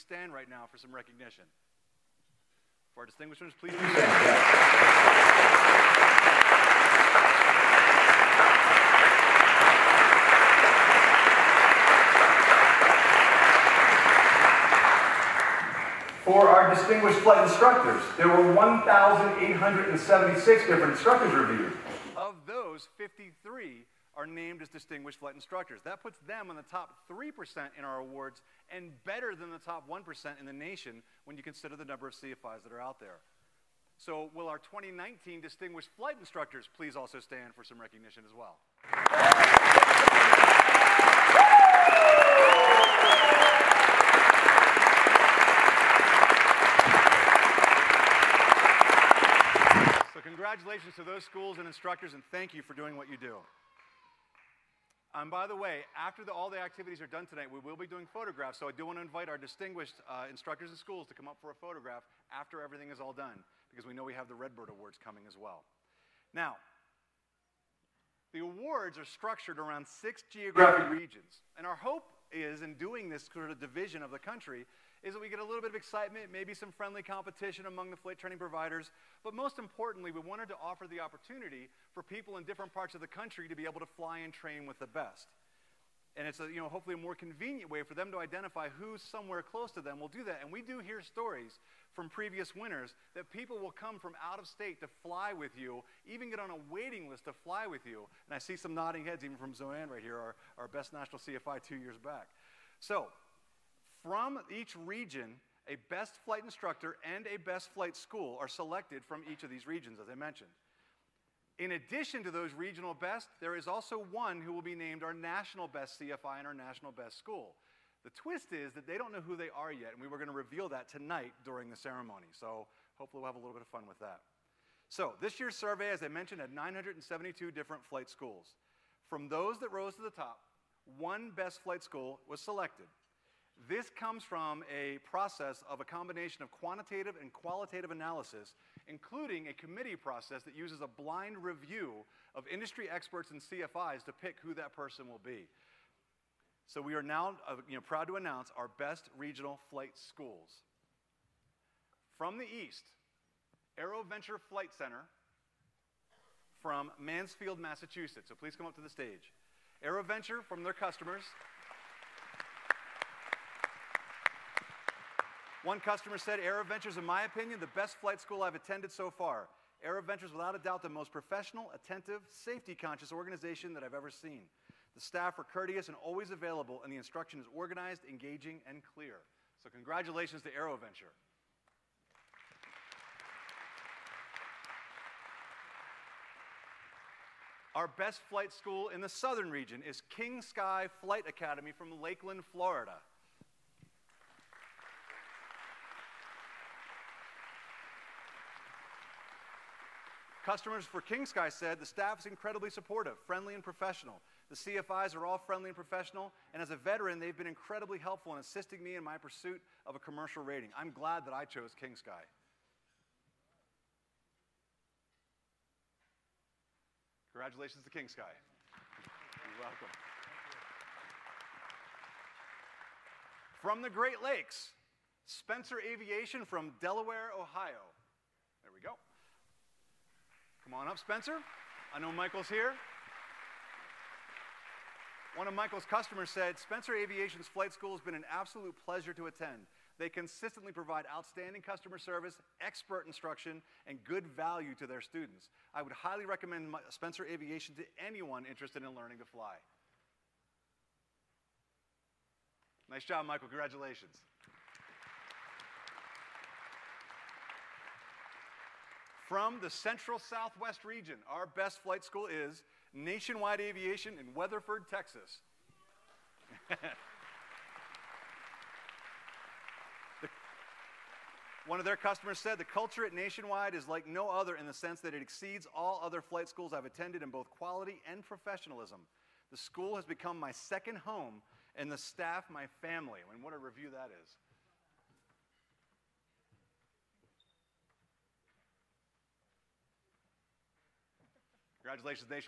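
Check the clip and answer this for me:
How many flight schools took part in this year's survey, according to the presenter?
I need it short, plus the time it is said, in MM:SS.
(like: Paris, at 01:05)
972, at 02:06.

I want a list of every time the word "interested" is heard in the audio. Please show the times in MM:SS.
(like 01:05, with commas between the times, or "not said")
04:08.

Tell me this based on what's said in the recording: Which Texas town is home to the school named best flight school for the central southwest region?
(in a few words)
Weatherford.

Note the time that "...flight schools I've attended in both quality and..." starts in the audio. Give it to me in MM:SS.
04:36.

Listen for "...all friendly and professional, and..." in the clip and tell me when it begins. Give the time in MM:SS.
03:25.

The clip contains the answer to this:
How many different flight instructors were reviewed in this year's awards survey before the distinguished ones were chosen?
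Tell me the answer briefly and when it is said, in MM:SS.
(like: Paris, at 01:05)
1,876, at 00:18.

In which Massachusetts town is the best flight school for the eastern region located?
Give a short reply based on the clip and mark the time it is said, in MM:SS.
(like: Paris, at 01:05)
Mansfield, at 02:36.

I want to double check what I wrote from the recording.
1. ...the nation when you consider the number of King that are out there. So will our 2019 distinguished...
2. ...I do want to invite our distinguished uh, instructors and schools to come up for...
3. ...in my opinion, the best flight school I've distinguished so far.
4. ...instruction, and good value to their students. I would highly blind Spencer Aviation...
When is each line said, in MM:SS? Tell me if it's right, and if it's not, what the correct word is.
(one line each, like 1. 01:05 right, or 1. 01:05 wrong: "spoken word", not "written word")
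1. 00:30 wrong: "CFIs", not "King"
2. 00:58 right
3. 02:46 wrong: "attended", not "distinguished"
4. 04:03 wrong: "recommend", not "blind".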